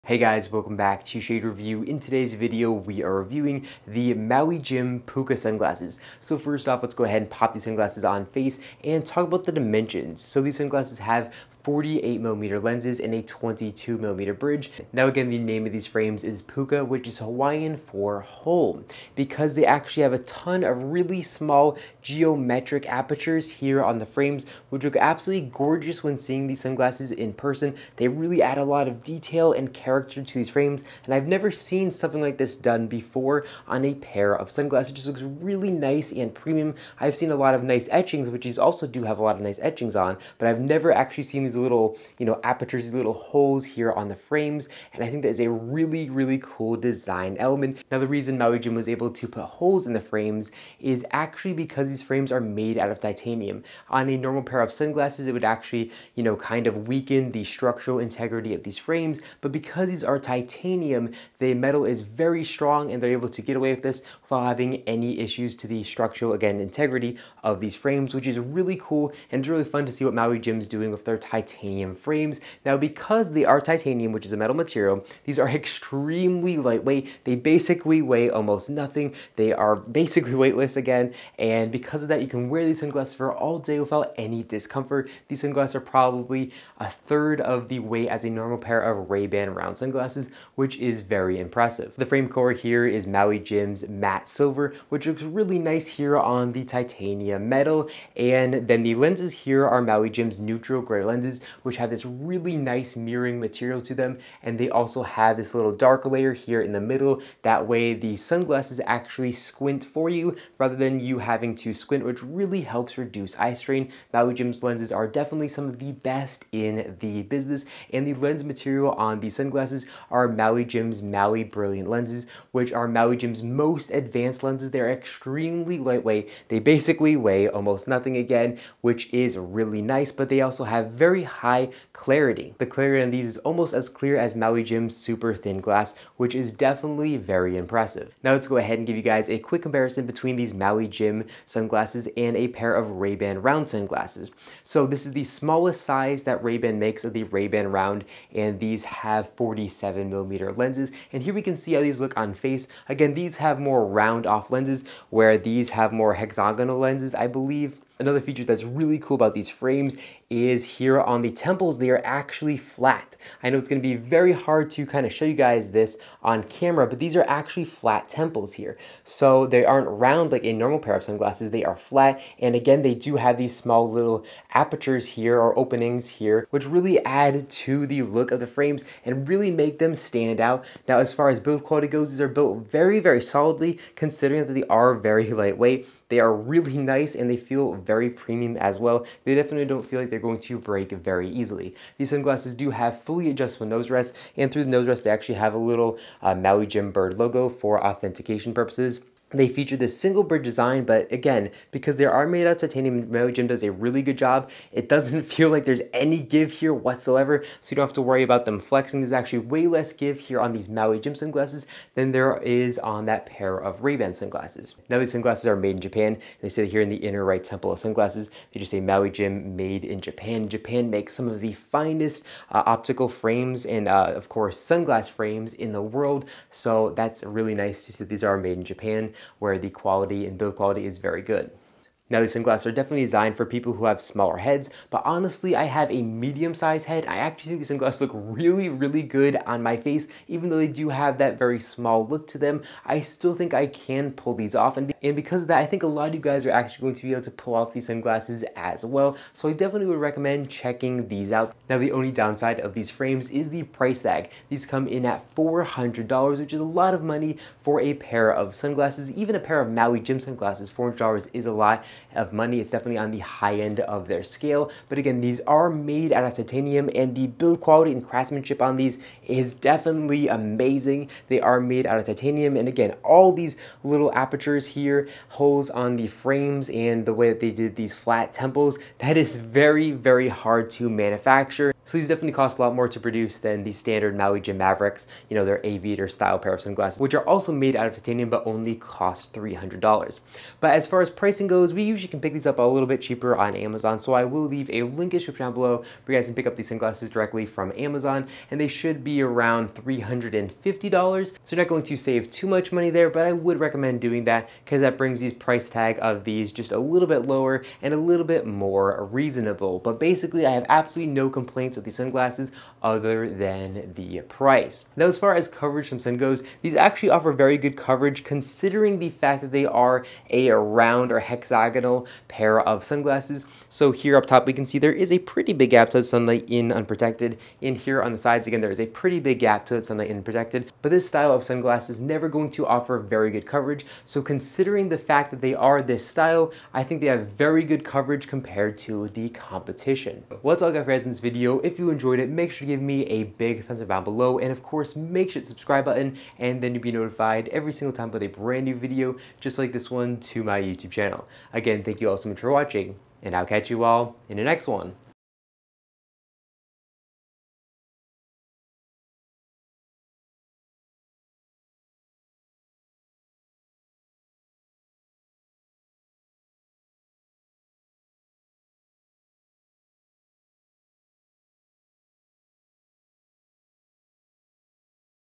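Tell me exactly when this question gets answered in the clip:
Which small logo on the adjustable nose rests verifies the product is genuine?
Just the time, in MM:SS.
03:16.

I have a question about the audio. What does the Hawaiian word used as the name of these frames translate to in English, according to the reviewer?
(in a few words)
hole.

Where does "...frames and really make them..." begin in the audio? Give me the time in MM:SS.
02:58.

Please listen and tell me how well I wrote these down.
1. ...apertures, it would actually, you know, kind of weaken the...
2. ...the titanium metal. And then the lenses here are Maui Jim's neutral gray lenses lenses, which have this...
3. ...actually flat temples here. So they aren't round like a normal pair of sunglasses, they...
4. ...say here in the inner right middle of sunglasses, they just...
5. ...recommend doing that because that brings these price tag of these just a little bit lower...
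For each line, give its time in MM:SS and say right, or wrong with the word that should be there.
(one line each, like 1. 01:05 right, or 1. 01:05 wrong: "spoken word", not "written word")
1. 00:54 wrong: "sunglasses", not "apertures"
2. 01:36 right
3. 02:47 right
4. 03:36 wrong: "temple", not "middle"
5. 05:03 right.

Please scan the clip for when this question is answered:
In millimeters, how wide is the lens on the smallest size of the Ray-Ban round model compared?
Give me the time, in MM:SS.
02:29.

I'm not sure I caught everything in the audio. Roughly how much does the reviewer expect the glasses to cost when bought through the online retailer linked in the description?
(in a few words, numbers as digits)
$350.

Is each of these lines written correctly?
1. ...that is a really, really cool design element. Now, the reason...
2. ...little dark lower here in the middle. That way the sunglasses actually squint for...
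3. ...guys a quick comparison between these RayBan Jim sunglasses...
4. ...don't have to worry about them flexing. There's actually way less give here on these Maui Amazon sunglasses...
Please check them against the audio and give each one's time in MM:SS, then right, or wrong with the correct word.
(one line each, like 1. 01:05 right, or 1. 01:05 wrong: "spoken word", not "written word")
1. 00:45 right
2. 01:45 wrong: "layer", not "lower"
3. 02:19 wrong: "Maui", not "RayBan"
4. 03:27 wrong: "Jim", not "Amazon".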